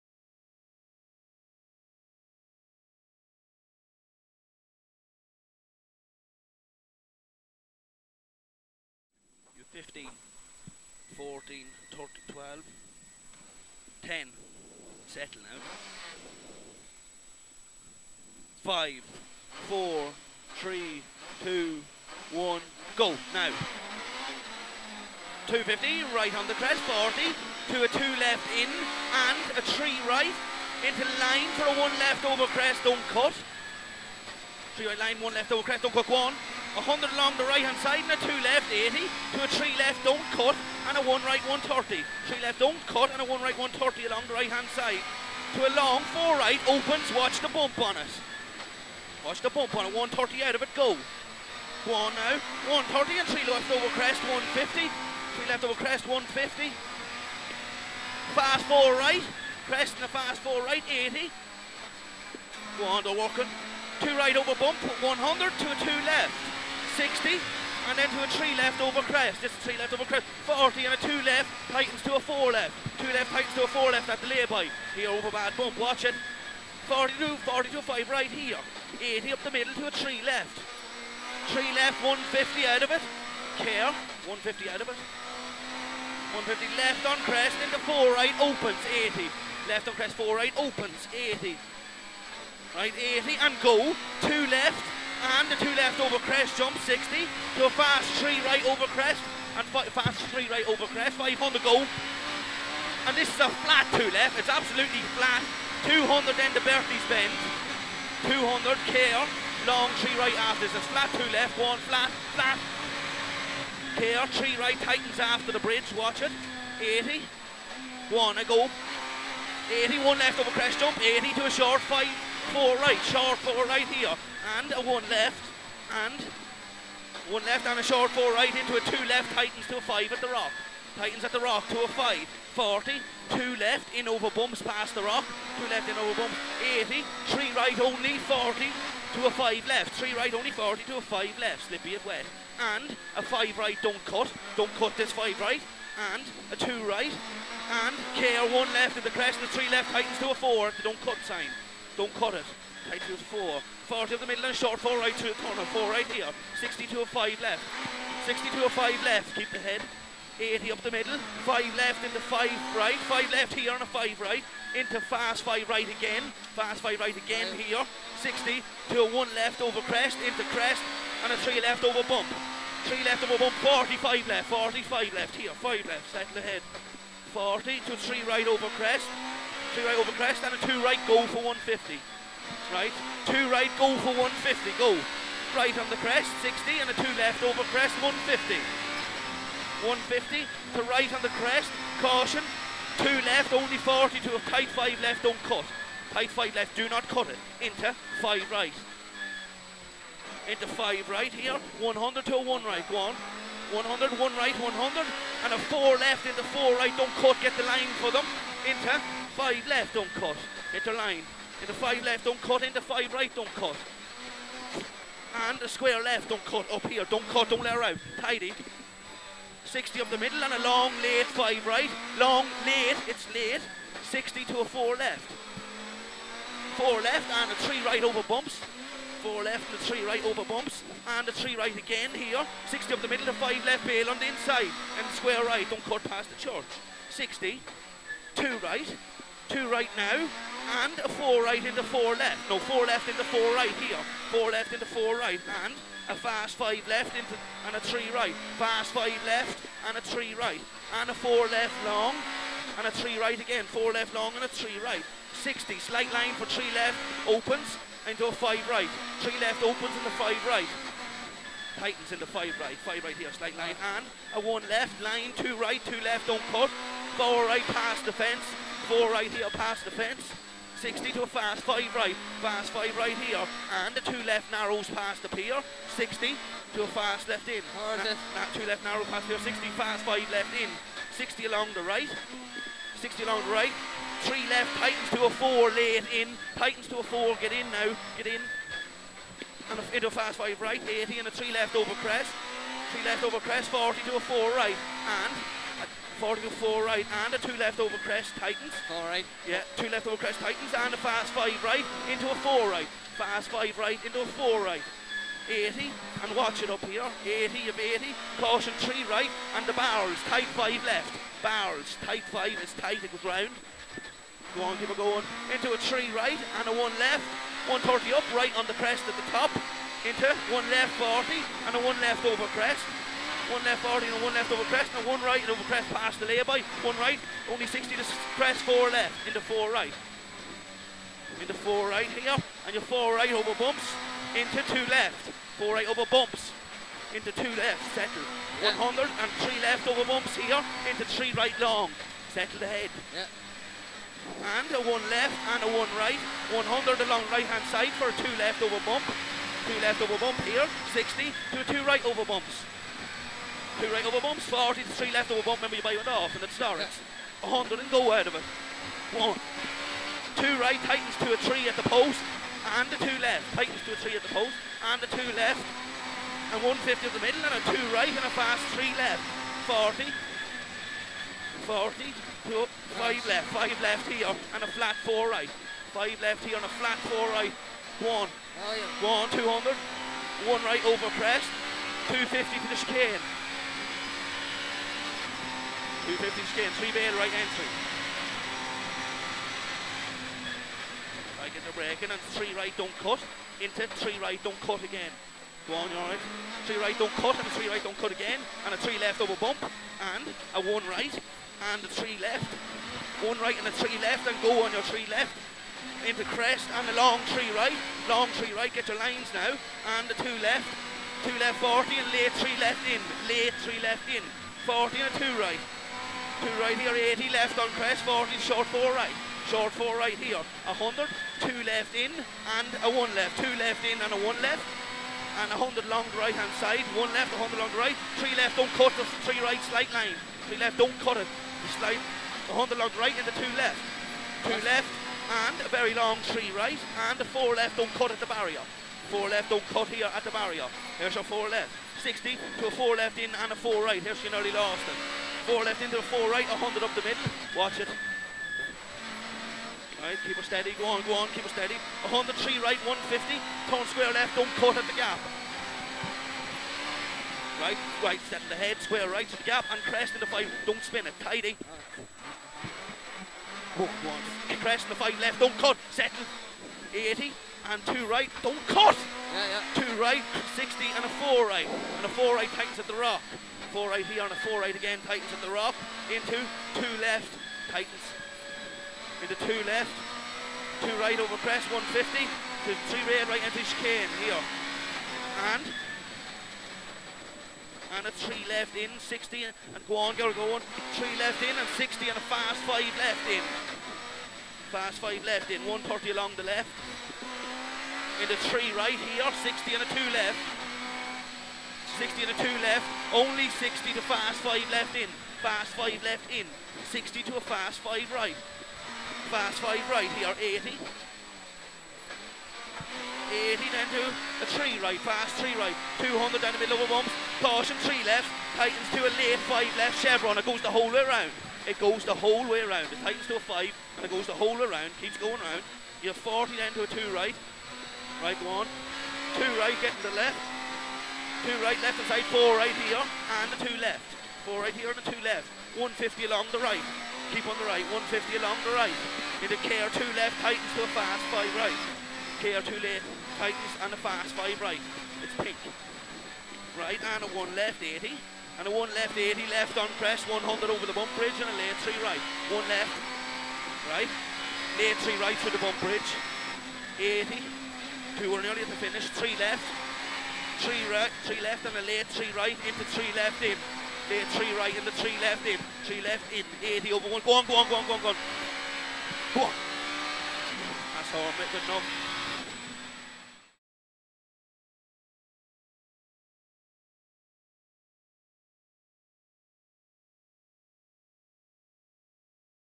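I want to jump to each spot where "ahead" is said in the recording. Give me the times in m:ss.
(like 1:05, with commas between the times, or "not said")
2:56, 5:42.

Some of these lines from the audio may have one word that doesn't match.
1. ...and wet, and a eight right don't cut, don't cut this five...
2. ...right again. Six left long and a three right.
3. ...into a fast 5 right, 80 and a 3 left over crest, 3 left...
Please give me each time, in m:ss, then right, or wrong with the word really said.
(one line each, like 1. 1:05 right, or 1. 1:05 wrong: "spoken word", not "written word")
1. 2:21 wrong: "five", not "eight"
2. 4:13 wrong: "Four", not "Six"
3. 4:49 right.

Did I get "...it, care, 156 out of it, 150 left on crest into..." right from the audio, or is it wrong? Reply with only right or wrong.
wrong.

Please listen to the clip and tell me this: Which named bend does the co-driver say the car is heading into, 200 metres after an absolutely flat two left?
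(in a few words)
Berthie's bend.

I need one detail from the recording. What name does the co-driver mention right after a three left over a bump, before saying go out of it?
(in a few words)
Norris.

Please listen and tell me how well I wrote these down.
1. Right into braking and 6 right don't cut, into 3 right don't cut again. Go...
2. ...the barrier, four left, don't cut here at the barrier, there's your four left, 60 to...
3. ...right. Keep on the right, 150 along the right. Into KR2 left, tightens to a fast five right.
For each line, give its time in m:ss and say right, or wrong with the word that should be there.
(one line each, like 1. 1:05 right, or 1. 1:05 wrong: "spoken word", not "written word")
1. 6:31 wrong: "3", not "6"
2. 7:18 right
3. 8:56 right.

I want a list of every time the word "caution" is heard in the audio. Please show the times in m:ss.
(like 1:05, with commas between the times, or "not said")
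3:12, 5:08, 8:37.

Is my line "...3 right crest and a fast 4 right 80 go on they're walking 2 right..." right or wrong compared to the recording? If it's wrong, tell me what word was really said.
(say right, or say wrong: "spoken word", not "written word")
wrong: "4", not "3".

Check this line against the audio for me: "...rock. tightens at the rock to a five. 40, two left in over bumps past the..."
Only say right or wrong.
right.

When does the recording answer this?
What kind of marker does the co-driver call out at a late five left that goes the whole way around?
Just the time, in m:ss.
8:40.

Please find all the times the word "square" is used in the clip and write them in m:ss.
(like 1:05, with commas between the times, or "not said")
3:35, 3:55, 7:33, 7:38.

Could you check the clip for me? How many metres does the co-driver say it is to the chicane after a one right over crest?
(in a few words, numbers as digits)
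250.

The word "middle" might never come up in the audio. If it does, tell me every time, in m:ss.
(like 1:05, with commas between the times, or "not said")
1:19, 2:34, 2:40, 3:40, 3:53, 6:07, 7:27, 8:36.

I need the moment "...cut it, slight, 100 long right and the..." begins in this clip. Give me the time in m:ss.
7:11.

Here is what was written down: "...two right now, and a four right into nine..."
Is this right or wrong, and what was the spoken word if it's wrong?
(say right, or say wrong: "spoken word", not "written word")
wrong: "four", not "nine".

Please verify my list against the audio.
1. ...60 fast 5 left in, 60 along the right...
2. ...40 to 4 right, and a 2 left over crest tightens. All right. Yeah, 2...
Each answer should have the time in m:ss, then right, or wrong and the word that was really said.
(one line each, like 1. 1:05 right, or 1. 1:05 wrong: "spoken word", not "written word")
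1. 4:39 right
2. 4:56 right.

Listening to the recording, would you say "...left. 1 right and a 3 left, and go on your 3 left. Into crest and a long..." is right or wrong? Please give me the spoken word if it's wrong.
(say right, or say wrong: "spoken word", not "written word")
right.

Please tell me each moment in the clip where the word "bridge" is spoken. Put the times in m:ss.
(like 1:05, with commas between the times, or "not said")
1:55, 9:11, 9:15.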